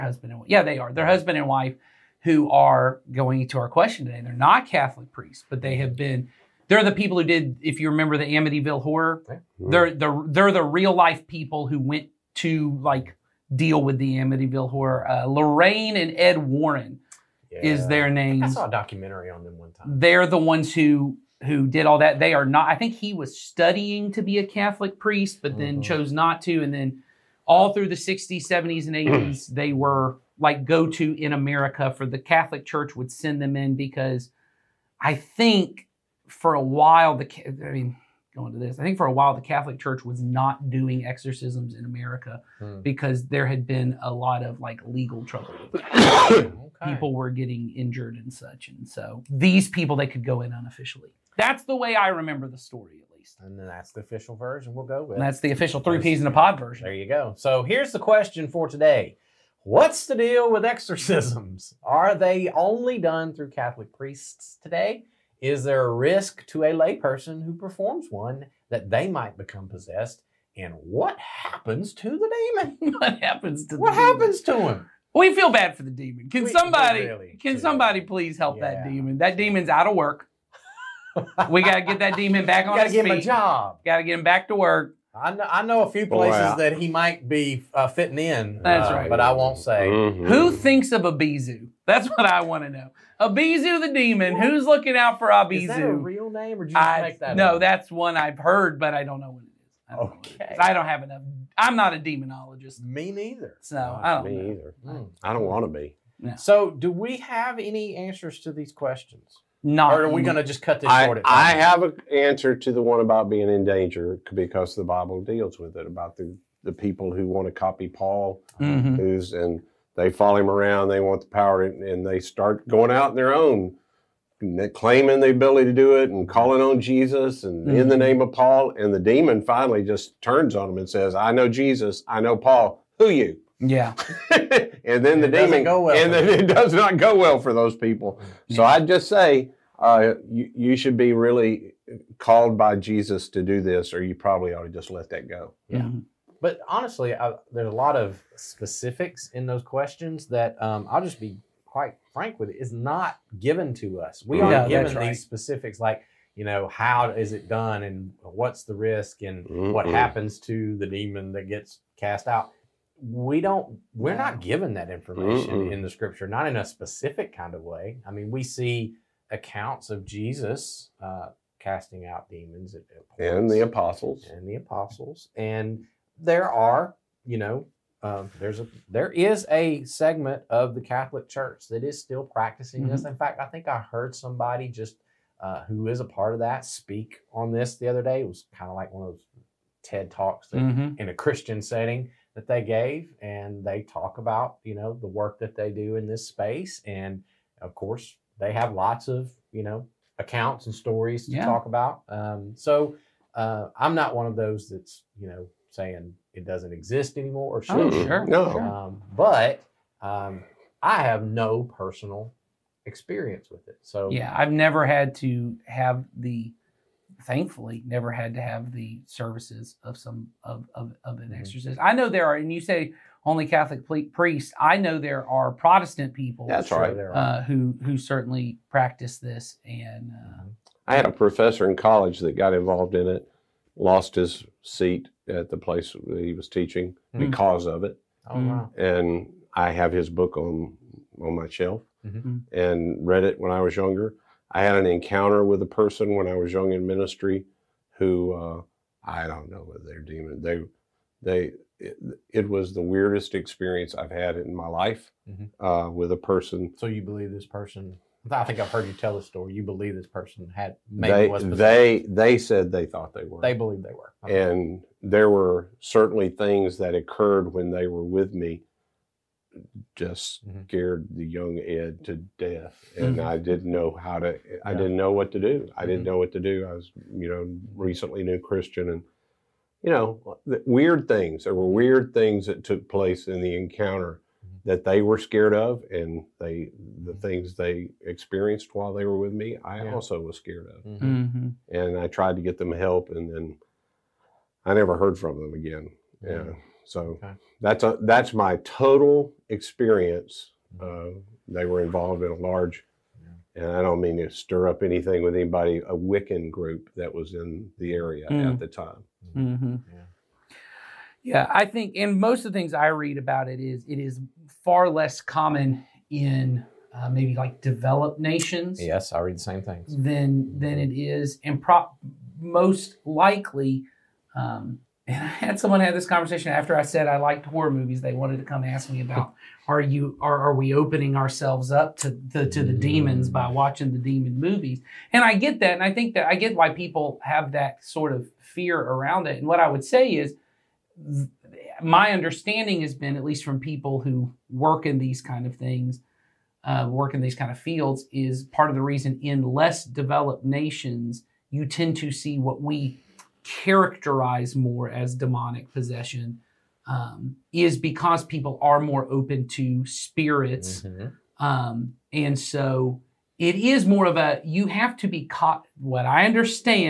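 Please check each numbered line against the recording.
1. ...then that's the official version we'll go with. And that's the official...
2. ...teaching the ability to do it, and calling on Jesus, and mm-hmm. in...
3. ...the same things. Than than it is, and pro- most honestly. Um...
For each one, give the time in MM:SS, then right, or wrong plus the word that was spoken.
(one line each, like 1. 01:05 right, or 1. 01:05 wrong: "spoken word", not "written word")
1. 00:53 right
2. 02:04 wrong: "claiming", not "teaching"
3. 05:19 wrong: "likely", not "honestly".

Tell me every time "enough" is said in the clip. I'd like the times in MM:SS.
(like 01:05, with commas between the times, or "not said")
01:41.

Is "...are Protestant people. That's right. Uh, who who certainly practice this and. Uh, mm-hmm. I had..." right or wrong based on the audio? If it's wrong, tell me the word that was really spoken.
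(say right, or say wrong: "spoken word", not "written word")
right.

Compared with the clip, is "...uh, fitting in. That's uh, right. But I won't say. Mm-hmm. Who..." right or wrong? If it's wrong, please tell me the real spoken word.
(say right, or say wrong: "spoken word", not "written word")
right.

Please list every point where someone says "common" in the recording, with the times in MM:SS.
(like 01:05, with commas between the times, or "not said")
05:15.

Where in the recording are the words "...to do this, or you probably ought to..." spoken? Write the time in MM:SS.
02:23.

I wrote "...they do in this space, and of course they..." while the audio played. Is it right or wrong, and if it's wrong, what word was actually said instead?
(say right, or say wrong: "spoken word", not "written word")
right.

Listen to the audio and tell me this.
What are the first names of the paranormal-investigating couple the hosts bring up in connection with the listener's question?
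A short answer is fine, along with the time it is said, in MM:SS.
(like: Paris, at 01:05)
Lorraine and Ed, at 00:15.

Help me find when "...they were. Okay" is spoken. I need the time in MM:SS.
04:23.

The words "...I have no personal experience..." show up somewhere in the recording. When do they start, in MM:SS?
03:30.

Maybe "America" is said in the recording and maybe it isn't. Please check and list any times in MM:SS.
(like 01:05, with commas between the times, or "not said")
00:31, 00:41.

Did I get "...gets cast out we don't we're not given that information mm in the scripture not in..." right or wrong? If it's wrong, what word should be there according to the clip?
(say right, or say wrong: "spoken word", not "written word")
right.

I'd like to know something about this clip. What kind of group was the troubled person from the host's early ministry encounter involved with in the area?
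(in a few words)
A Wiccan group.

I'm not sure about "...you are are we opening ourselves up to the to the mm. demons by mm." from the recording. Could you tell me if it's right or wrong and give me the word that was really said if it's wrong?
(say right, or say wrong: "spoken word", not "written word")
right.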